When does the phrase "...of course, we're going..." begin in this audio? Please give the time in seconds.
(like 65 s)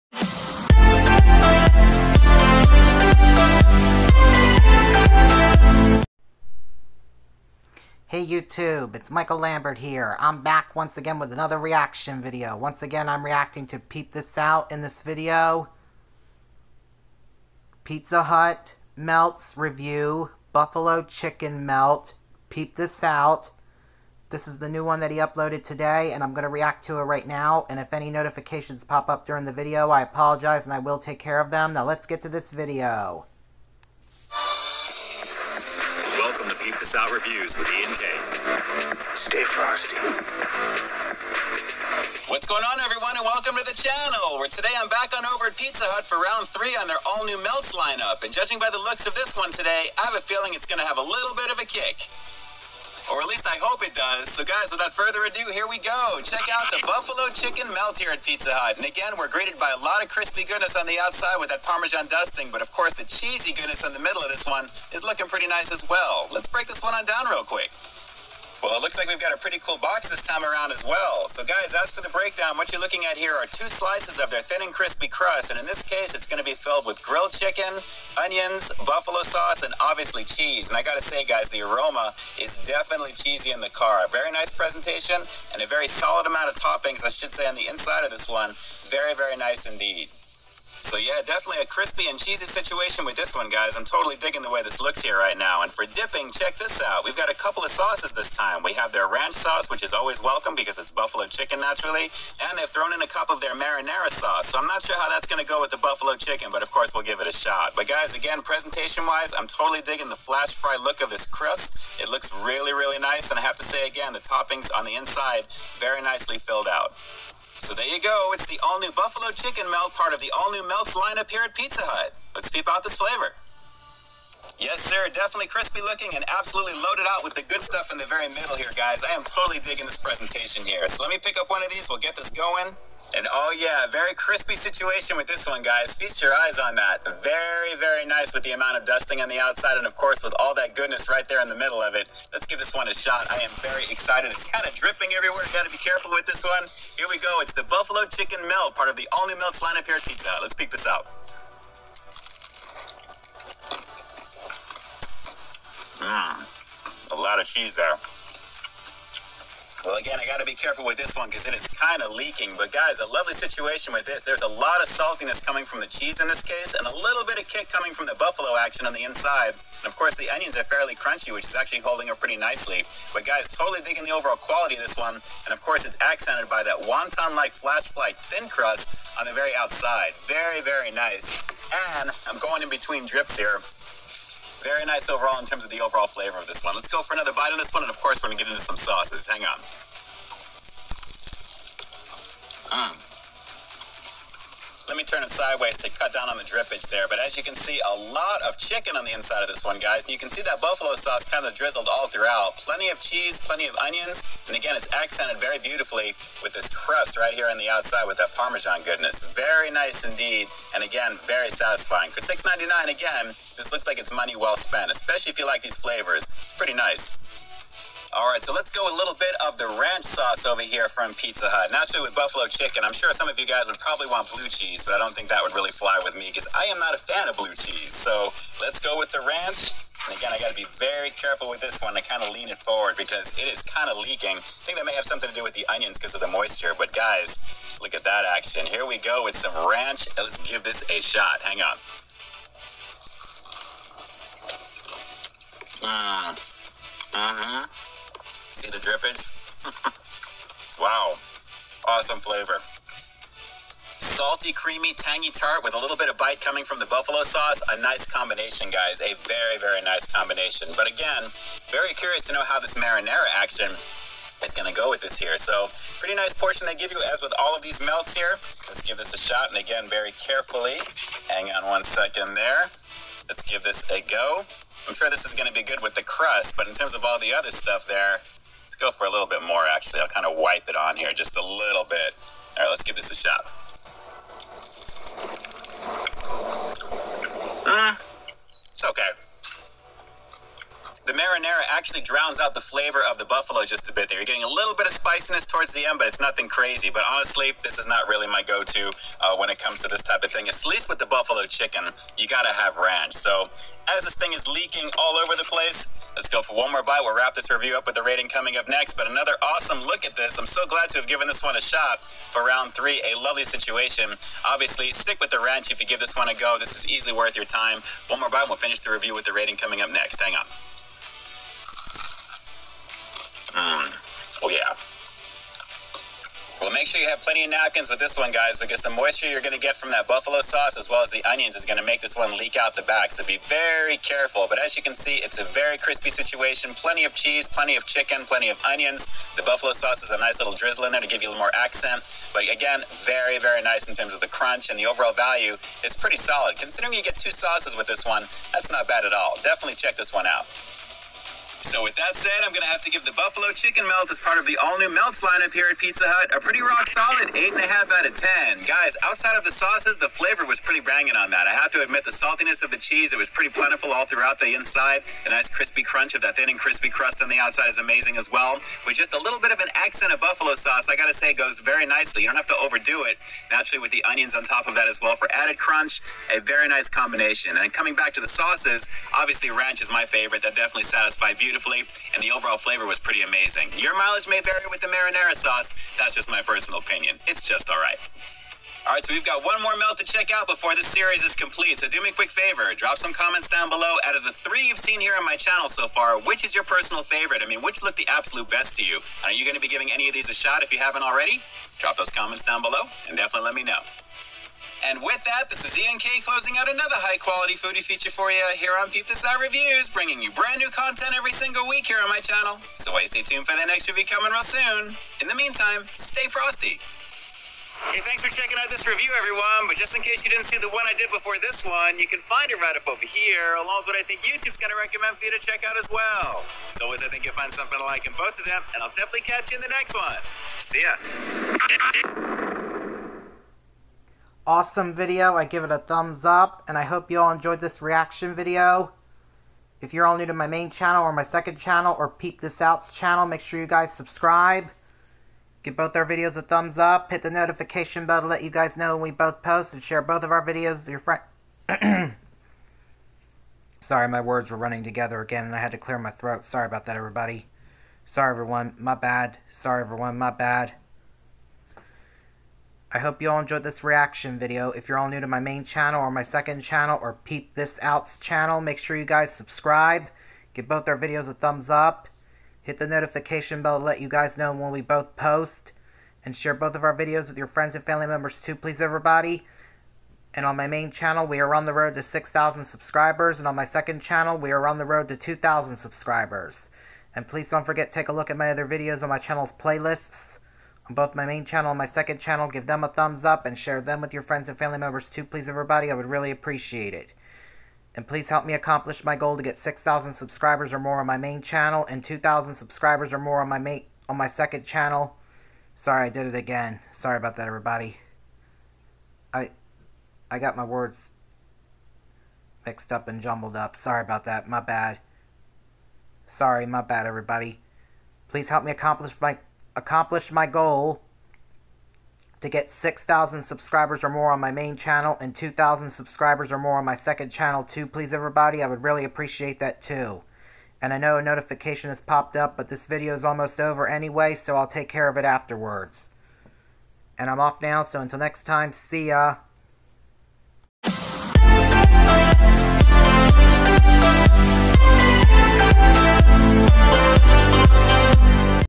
187 s.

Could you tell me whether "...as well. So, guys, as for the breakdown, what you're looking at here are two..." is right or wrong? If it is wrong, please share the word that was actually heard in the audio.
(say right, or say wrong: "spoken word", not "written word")
right.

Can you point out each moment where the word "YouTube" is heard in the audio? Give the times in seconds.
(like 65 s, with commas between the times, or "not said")
8 s, 424 s.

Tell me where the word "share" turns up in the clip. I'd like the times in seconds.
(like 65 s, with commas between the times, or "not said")
449 s, 476 s, 493 s.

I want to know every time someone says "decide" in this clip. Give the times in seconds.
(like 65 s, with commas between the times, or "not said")
not said.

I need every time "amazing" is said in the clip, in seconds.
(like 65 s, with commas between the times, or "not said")
367 s, 383 s.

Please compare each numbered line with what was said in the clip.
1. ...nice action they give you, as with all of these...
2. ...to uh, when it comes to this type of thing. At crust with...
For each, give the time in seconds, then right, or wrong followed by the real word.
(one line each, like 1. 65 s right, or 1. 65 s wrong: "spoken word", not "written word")
1. 266 s wrong: "portion", not "action"
2. 298 s wrong: "least", not "crust".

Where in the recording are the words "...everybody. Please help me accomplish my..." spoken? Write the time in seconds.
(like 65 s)
517 s.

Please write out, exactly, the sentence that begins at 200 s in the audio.
And you can see that buffalo sauce kind of drizzled all throughout.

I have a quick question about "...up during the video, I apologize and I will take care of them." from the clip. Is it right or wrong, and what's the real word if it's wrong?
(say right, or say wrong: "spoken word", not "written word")
right.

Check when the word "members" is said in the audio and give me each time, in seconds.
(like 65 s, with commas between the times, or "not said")
478 s, 494 s.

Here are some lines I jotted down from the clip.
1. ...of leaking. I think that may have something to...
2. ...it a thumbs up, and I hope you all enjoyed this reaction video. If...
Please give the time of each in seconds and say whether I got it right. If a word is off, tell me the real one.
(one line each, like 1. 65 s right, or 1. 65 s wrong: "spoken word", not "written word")
1. 233 s right
2. 435 s right.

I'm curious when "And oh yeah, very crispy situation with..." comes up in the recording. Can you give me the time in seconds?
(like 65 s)
133 s.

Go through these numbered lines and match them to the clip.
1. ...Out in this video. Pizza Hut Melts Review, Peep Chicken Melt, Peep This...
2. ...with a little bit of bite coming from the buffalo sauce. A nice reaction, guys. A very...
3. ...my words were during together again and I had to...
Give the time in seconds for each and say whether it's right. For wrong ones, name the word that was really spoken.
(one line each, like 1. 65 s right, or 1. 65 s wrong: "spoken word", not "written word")
1. 14 s wrong: "Buffalo", not "Peep"
2. 255 s wrong: "combination", not "reaction"
3. 454 s wrong: "running", not "during".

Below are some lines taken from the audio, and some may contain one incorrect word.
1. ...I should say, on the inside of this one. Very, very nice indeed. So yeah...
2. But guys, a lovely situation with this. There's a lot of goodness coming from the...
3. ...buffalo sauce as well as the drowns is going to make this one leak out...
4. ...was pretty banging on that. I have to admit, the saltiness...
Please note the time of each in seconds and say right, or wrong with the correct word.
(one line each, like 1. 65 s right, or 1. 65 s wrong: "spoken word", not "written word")
1. 87 s right
2. 162 s wrong: "saltiness", not "goodness"
3. 330 s wrong: "onions", not "drowns"
4. 360 s right.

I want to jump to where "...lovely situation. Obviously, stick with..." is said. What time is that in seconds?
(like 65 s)
313 s.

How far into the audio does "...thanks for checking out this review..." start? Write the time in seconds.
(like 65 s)
418 s.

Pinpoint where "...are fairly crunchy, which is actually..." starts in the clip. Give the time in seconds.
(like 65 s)
170 s.